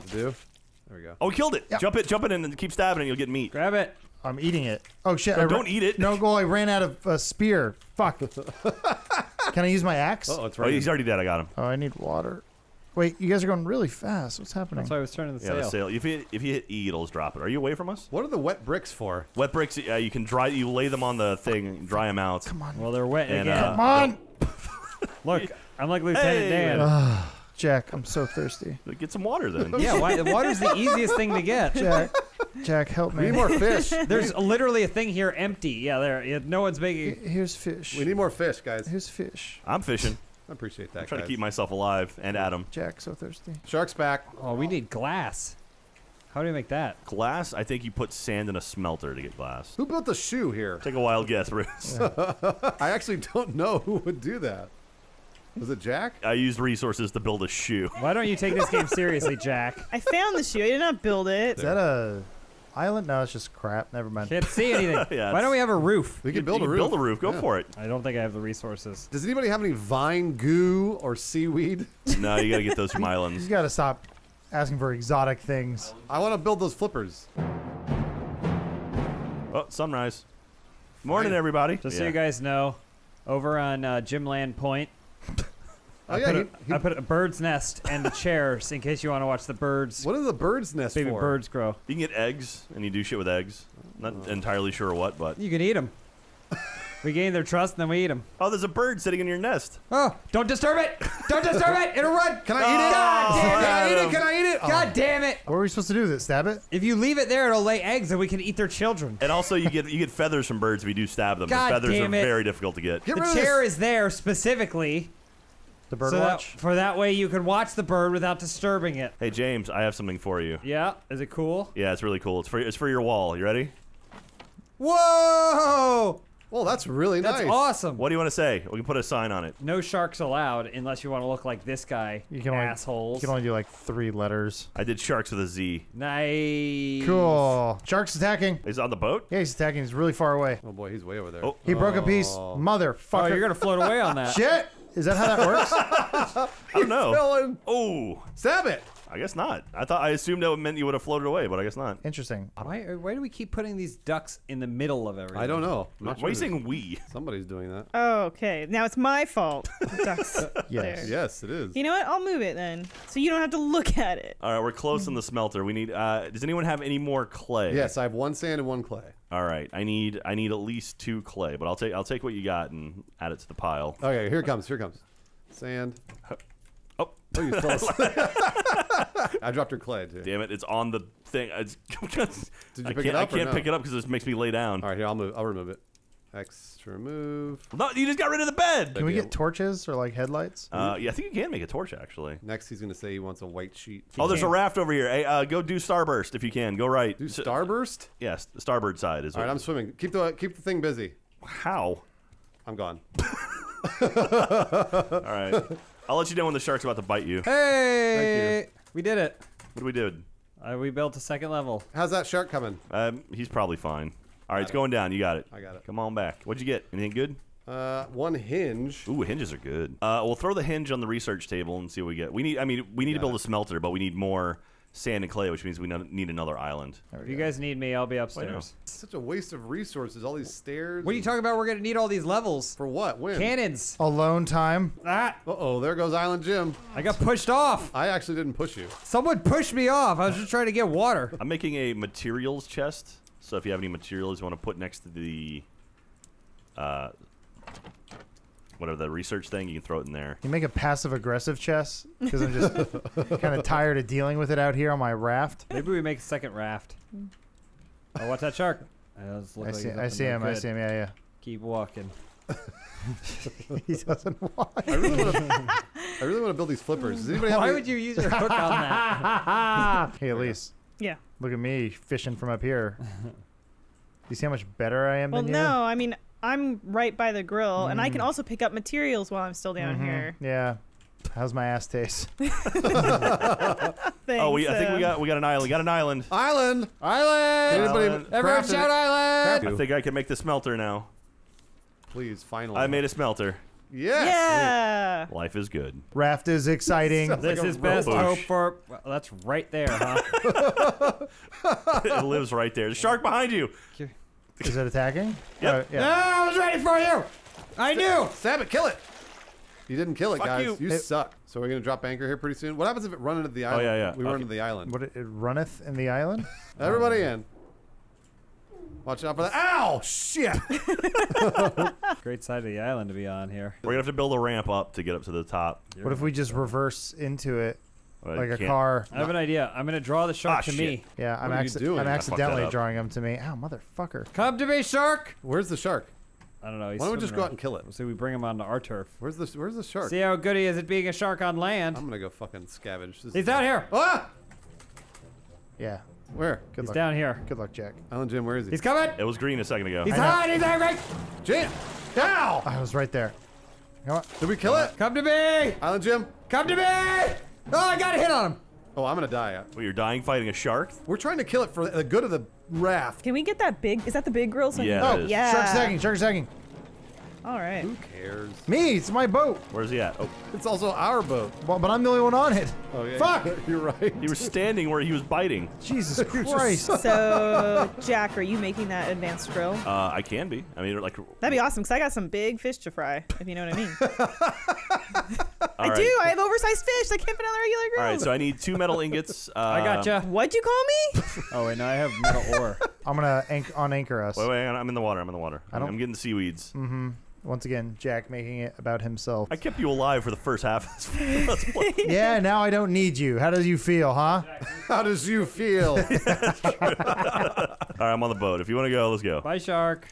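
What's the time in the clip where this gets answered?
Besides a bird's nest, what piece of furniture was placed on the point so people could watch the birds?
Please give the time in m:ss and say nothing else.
1:28.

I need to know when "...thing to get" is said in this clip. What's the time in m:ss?
0:31.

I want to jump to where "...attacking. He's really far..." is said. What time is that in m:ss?
2:19.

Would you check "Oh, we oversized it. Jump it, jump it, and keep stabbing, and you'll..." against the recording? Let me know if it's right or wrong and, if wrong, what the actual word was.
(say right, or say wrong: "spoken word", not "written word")
wrong: "killed", not "oversized".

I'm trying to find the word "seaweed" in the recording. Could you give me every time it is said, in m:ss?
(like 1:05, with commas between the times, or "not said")
1:11, 6:36.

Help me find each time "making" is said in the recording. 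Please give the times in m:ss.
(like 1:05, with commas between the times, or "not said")
0:36, 4:01, 6:18, 6:38.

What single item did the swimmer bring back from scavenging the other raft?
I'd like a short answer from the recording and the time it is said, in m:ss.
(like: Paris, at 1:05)
One hinge, at 3:38.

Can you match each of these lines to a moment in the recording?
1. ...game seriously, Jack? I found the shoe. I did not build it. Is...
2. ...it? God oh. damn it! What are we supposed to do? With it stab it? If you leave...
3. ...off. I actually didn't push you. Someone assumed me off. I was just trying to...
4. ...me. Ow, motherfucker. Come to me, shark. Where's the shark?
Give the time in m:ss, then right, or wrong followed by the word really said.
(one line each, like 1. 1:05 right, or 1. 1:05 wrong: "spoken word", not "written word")
1. 0:58 right
2. 1:44 right
3. 3:57 wrong: "pushed", not "assumed"
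4. 5:33 right.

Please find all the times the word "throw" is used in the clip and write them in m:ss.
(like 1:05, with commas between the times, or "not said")
3:40, 4:09.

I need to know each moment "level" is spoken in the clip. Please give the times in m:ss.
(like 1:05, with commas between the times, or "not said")
3:31, 3:52.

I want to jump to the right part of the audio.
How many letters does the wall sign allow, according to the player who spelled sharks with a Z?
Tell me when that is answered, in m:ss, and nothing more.
2:13.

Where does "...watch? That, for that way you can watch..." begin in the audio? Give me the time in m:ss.
1:56.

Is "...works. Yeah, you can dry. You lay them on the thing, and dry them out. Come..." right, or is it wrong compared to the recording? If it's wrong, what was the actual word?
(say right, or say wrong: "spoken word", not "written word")
wrong: "bricks", not "works".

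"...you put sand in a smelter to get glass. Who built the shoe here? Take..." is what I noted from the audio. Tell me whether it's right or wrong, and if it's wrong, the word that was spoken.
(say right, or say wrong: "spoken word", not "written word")
right.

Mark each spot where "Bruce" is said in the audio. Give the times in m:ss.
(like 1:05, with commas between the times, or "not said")
0:51.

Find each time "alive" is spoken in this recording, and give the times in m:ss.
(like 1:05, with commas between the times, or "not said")
0:41, 6:39.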